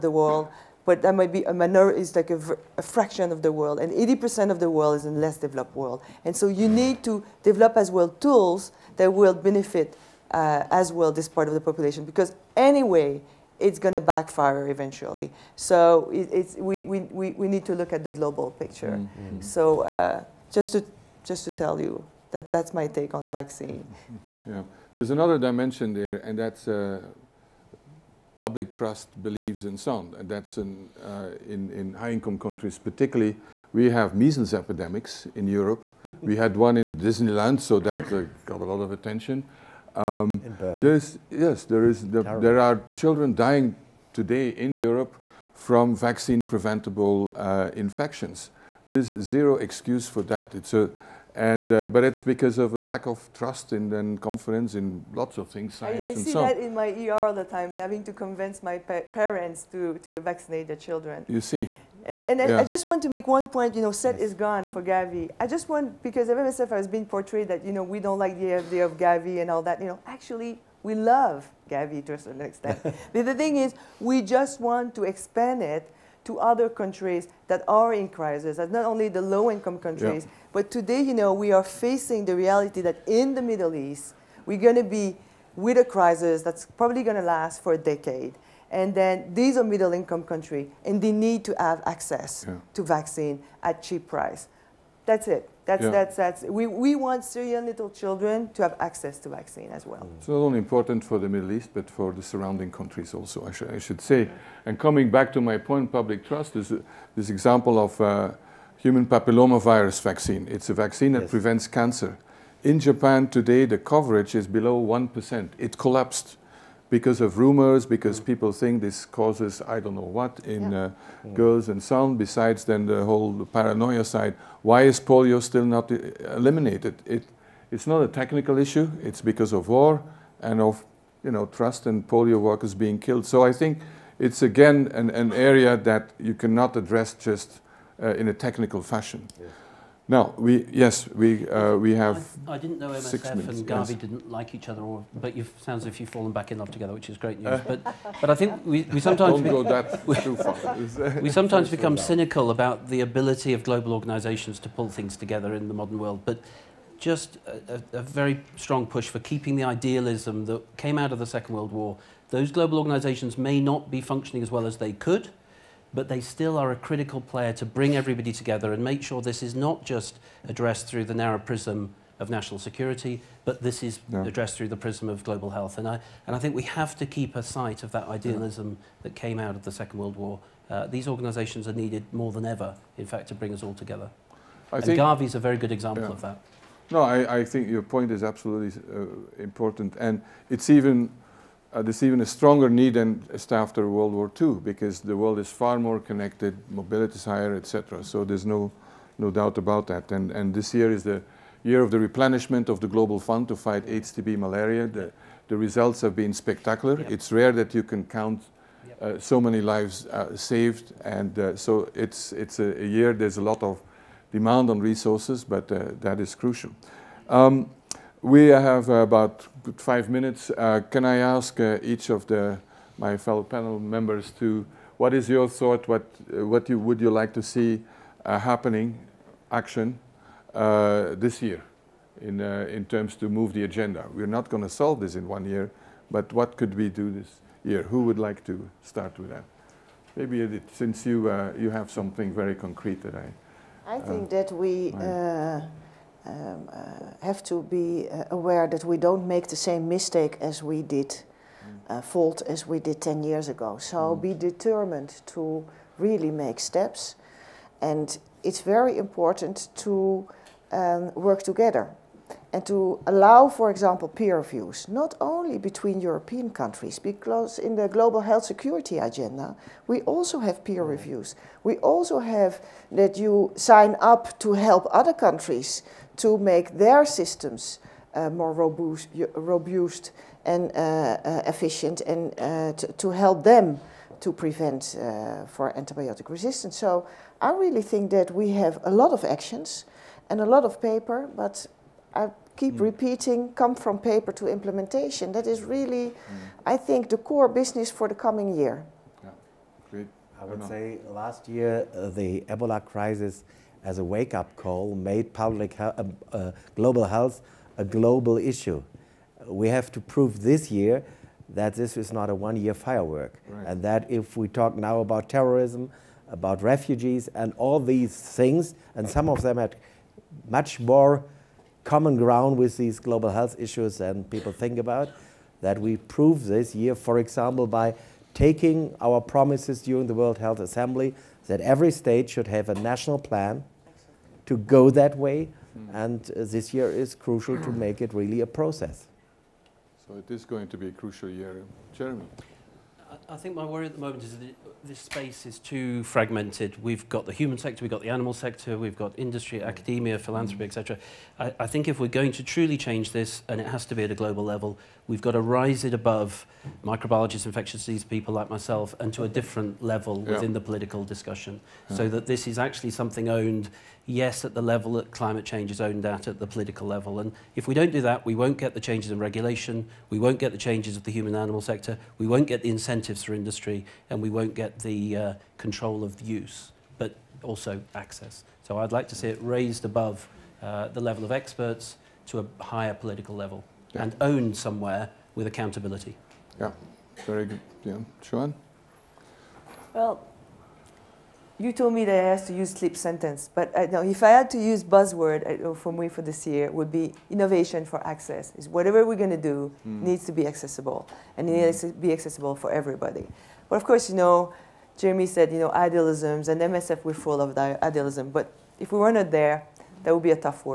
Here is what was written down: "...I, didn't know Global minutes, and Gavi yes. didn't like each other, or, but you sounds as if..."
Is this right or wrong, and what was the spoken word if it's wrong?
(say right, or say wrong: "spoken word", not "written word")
wrong: "MSF", not "Global".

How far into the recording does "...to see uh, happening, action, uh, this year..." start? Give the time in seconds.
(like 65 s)
227 s.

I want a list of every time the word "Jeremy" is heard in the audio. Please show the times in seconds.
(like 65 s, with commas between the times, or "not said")
341 s, 404 s.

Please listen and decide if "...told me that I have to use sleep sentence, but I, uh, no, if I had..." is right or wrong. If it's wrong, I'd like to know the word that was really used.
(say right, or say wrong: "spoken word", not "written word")
right.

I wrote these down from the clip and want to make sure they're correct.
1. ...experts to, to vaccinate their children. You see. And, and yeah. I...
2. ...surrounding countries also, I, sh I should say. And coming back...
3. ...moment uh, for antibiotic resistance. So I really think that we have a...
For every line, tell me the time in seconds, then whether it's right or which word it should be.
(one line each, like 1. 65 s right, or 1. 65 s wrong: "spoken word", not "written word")
1. 59 s wrong: "parents", not "experts"
2. 102 s right
3. 284 s wrong: "prevent", not "moment".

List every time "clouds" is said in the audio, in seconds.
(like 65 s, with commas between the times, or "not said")
not said.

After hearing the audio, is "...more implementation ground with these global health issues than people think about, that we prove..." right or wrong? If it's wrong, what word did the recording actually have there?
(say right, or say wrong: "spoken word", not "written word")
wrong: "common", not "implementation".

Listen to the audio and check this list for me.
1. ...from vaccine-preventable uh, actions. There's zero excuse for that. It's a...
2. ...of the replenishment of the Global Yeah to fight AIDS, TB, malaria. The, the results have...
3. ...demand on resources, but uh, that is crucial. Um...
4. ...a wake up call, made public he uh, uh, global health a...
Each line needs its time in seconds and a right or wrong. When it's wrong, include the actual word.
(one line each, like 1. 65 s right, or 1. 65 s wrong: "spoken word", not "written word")
1. 45 s wrong: "infections", not "actions"
2. 201 s wrong: "Fund", not "Yeah"
3. 214 s right
4. 303 s right.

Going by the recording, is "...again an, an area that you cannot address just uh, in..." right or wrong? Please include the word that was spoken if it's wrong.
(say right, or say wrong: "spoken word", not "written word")
right.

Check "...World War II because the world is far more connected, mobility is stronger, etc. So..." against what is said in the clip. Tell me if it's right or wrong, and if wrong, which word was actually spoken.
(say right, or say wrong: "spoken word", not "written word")
wrong: "higher", not "stronger".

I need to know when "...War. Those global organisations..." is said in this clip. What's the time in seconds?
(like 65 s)
161 s.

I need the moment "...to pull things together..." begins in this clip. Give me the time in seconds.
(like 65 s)
154 s.